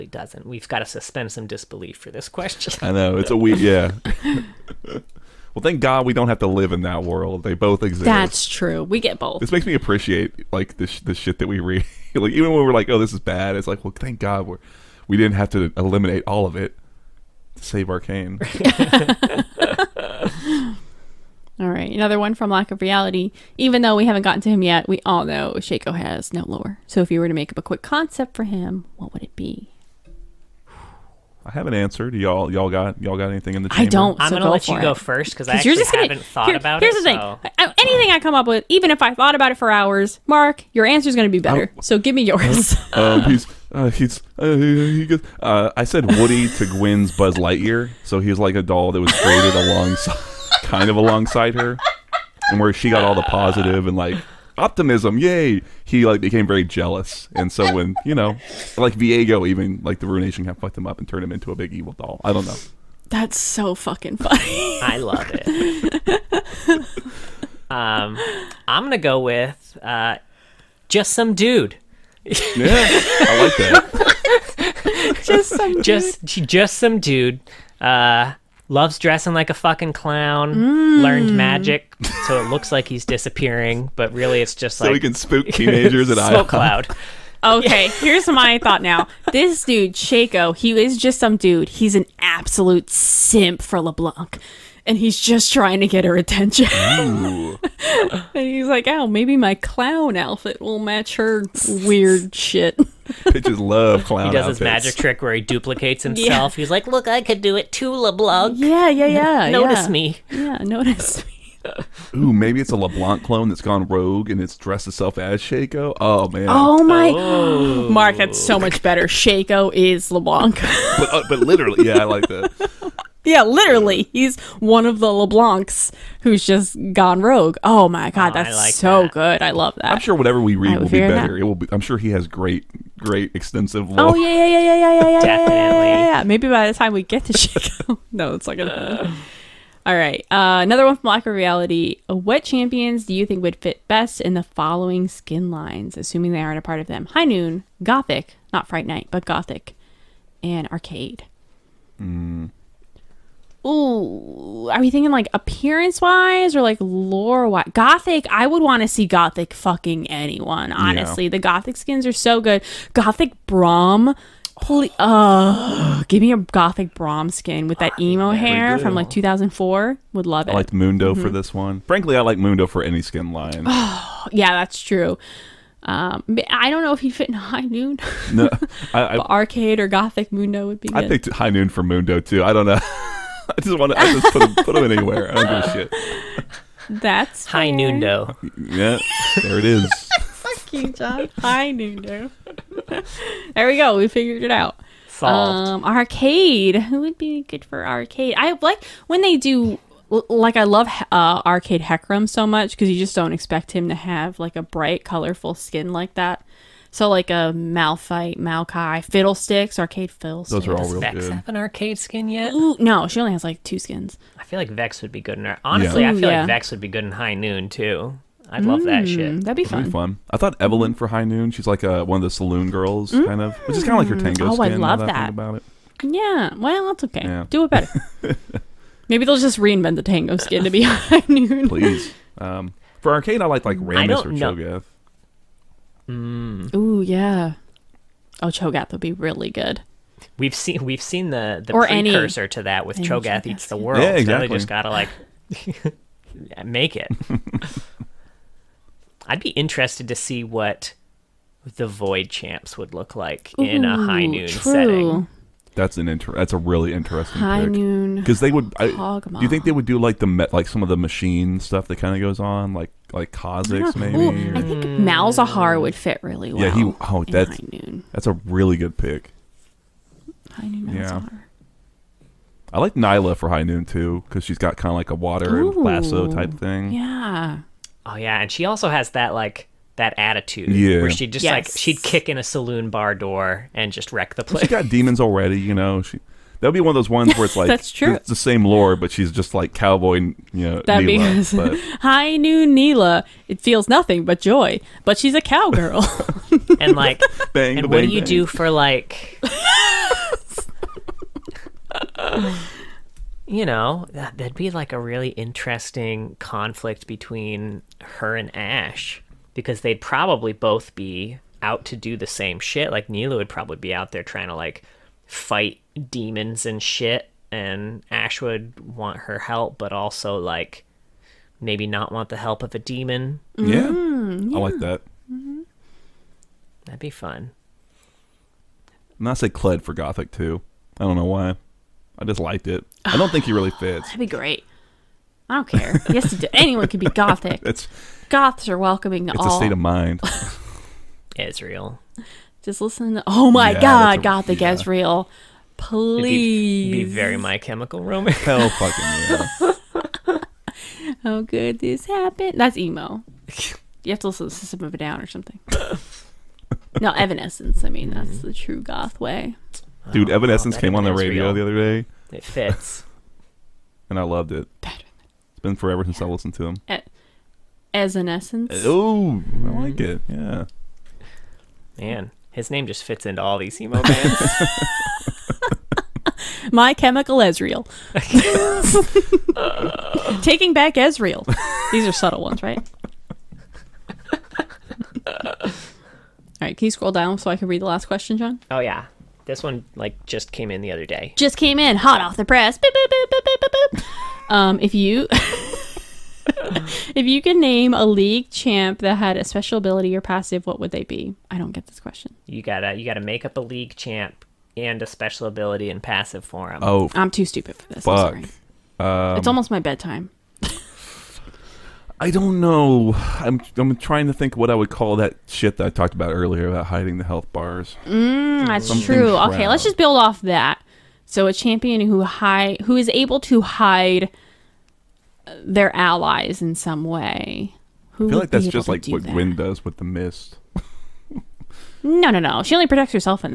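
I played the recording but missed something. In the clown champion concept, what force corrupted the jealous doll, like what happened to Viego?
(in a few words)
the Ruination.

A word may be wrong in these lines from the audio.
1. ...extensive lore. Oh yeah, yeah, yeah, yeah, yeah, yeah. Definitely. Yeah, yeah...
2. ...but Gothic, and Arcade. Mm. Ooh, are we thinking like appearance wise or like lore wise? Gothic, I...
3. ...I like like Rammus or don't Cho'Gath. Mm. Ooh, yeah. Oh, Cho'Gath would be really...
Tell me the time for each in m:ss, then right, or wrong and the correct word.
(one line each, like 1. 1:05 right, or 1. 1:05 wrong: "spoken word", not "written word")
1. 2:13 right
2. 2:29 right
3. 3:53 right.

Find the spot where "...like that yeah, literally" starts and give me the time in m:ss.
2:02.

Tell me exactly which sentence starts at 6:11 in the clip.
Man, his name just fits into all these emo bands.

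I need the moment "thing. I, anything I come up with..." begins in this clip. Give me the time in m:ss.
0:37.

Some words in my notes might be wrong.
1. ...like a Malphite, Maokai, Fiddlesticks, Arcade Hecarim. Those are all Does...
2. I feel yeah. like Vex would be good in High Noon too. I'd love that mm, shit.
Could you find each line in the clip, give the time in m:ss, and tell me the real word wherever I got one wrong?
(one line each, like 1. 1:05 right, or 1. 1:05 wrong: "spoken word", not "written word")
1. 3:27 wrong: "Fiddlesticks", not "Hecarim"
2. 3:36 right.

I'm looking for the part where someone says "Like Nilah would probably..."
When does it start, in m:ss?
5:12.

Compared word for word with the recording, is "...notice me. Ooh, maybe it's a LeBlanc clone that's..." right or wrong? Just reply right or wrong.
right.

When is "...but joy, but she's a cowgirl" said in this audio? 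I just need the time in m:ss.
4:54.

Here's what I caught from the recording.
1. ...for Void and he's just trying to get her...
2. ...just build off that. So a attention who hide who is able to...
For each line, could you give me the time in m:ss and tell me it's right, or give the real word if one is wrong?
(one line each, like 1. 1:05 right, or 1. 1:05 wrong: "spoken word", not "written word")
1. 1:33 wrong: "LeBlanc", not "Void"
2. 6:59 wrong: "champion", not "attention".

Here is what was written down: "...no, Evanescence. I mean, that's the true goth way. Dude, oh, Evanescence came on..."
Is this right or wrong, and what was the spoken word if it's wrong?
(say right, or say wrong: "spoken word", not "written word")
right.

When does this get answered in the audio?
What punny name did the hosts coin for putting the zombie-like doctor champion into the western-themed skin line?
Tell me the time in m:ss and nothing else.
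3:11.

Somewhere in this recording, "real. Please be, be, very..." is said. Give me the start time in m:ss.
5:44.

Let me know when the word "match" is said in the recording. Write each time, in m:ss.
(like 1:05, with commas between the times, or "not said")
1:40.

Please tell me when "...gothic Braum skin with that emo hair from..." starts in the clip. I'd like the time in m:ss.
2:46.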